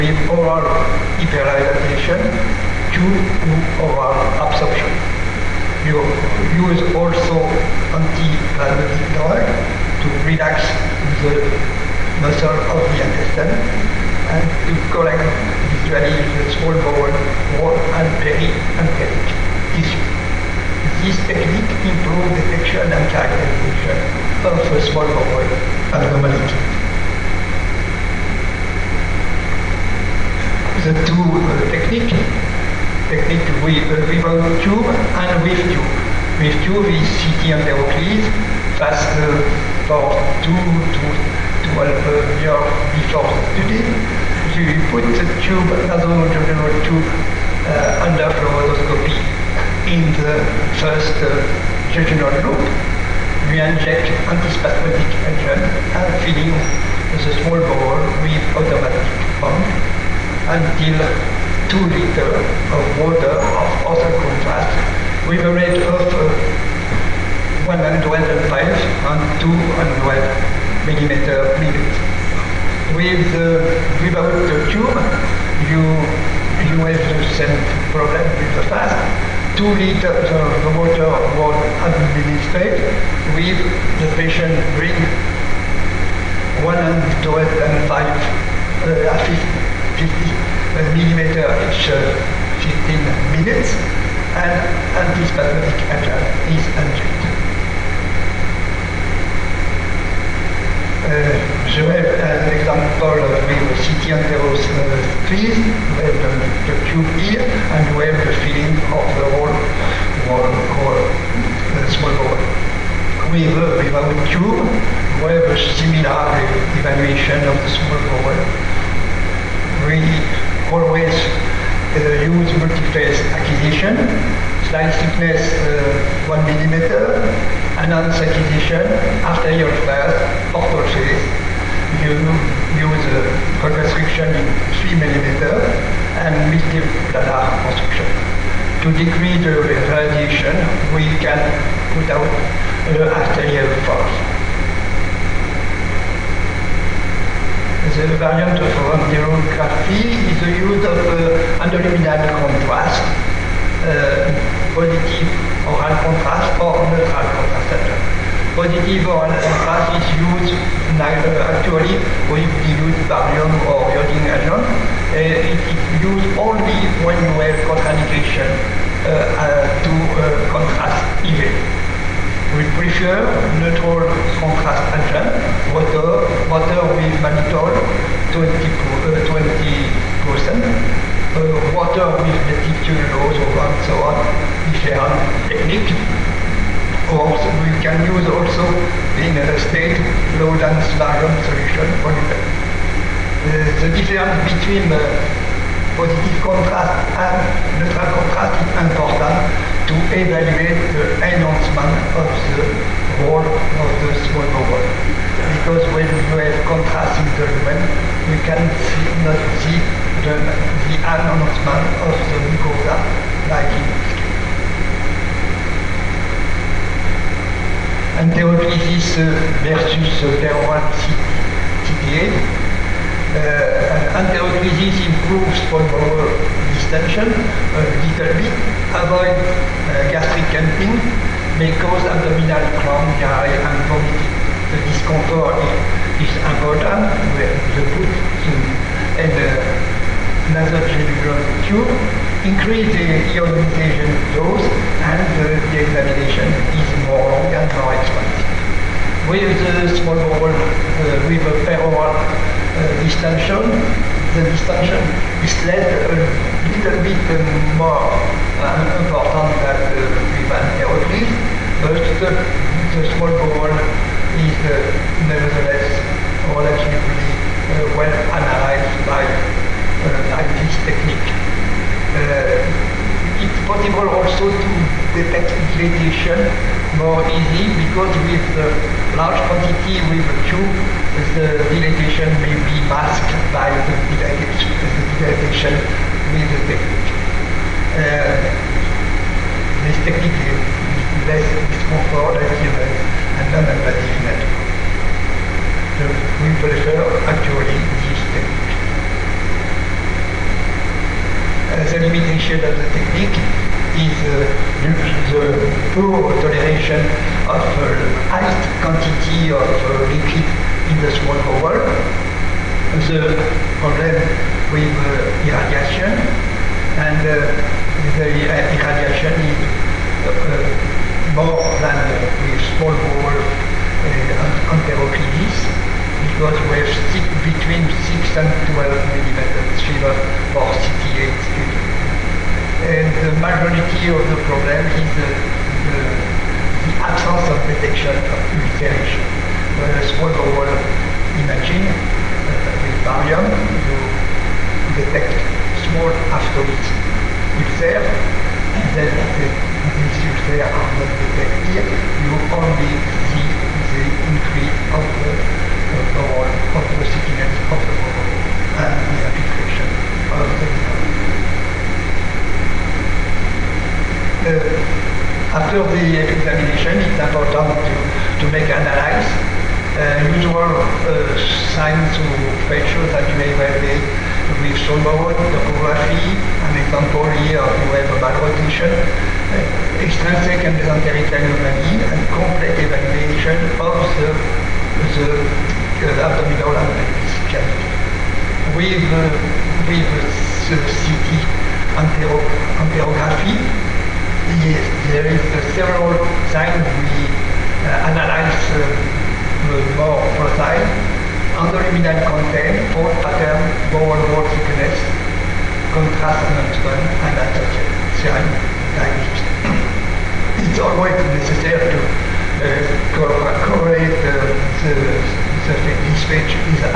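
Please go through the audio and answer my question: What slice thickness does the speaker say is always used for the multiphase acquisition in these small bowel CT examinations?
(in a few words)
1 millimeter.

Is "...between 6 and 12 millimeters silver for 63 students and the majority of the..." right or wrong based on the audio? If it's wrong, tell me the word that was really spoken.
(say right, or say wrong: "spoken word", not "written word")
wrong: "68", not "63".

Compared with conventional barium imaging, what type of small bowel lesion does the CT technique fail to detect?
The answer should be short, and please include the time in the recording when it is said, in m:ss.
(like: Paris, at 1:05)
ulcers, at 5:38.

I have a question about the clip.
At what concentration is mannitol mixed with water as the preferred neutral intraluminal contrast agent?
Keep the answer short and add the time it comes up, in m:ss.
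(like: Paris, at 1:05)
20 percent, at 2:58.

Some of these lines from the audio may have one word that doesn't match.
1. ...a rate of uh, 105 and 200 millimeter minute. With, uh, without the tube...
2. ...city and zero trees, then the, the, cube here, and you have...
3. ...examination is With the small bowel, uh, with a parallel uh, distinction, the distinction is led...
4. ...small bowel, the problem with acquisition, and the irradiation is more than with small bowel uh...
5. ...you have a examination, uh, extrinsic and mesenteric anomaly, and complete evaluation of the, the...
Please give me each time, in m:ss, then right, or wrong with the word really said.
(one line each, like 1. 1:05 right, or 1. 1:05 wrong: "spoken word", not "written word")
1. 1:05 right
2. 1:43 right
3. 4:05 right
4. 5:11 wrong: "irradiation", not "acquisition"
5. 6:17 wrong: "malrotation", not "examination".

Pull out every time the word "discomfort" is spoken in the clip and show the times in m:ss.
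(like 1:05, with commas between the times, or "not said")
3:54, 4:51.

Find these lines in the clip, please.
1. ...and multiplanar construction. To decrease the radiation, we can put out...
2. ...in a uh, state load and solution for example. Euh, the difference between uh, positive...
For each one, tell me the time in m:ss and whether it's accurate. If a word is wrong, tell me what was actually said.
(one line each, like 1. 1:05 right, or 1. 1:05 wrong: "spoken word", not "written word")
1. 2:16 right
2. 3:09 right.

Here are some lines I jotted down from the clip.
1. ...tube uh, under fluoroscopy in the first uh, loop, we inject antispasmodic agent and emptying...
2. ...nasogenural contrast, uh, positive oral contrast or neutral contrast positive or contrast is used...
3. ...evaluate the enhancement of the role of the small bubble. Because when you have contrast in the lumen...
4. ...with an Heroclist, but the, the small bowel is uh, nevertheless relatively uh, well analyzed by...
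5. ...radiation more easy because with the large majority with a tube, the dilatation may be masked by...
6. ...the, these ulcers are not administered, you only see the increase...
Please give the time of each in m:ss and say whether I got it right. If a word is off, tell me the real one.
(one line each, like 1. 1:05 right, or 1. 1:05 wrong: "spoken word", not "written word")
1. 0:46 wrong: "filling", not "emptying"
2. 2:31 wrong: "endoluminal", not "nasogenural"
3. 3:20 right
4. 4:20 right
5. 4:35 wrong: "quantity", not "majority"
6. 5:49 wrong: "detected", not "administered".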